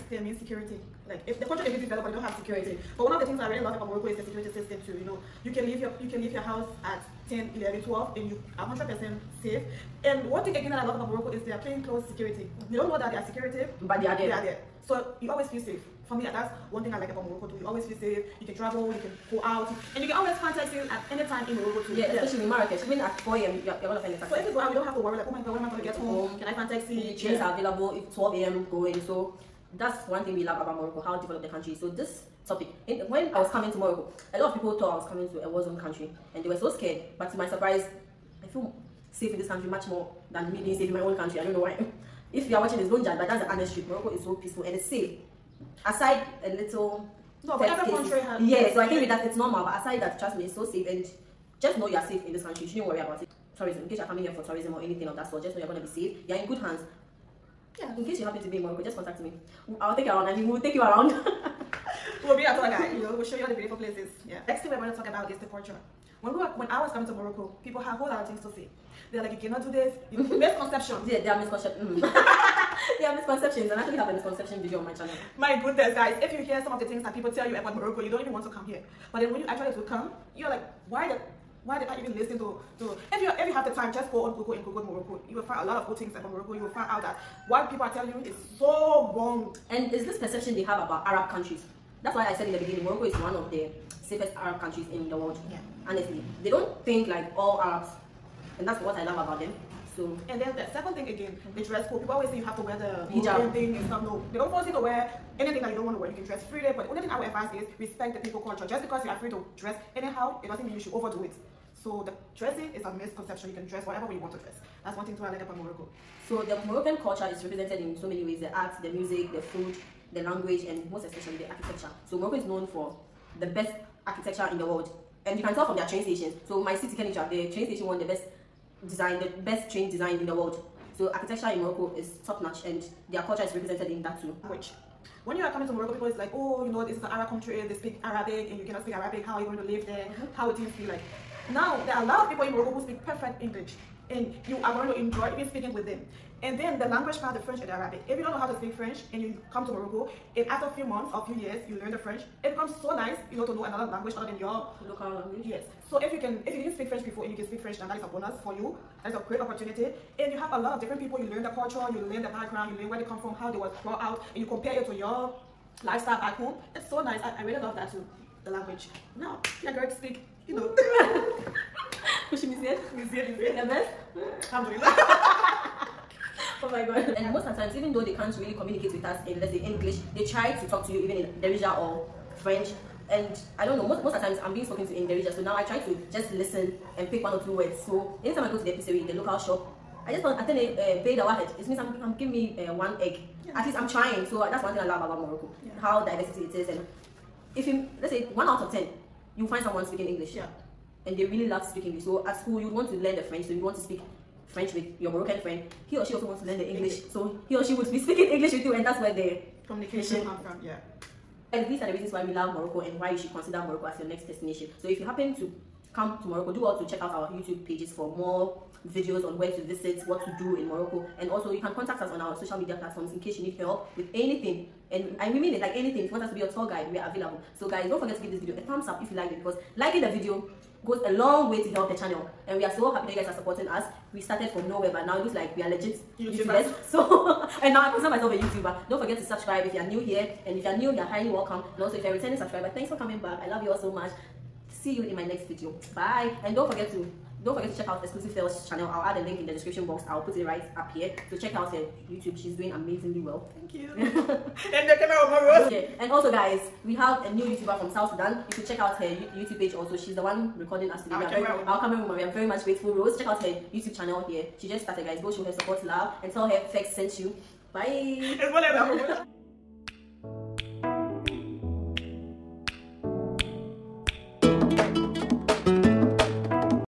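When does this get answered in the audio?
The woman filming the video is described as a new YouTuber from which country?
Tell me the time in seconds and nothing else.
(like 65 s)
257 s.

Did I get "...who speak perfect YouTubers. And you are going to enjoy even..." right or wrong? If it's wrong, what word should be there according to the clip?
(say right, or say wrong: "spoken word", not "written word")
wrong: "English", not "YouTubers".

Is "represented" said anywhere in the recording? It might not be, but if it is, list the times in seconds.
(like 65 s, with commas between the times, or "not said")
117 s, 133 s.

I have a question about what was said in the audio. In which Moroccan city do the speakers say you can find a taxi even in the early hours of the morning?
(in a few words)
Marrakesh.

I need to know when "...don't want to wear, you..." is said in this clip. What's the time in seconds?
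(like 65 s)
105 s.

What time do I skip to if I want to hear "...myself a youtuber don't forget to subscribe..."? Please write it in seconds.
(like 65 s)
238 s.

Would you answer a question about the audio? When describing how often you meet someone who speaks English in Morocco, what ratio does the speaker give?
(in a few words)
1 out of 10.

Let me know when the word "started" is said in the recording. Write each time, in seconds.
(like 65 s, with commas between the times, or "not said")
234 s, 264 s.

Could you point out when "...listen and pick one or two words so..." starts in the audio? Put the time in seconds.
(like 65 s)
186 s.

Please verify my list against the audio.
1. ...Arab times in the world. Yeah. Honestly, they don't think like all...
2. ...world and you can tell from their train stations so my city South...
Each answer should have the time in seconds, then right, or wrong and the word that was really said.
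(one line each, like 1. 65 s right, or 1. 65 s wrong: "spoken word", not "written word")
1. 94 s wrong: "countries", not "times"
2. 124 s wrong: "Kenitra", not "South".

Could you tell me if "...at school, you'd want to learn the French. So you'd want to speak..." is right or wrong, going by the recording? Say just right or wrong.
right.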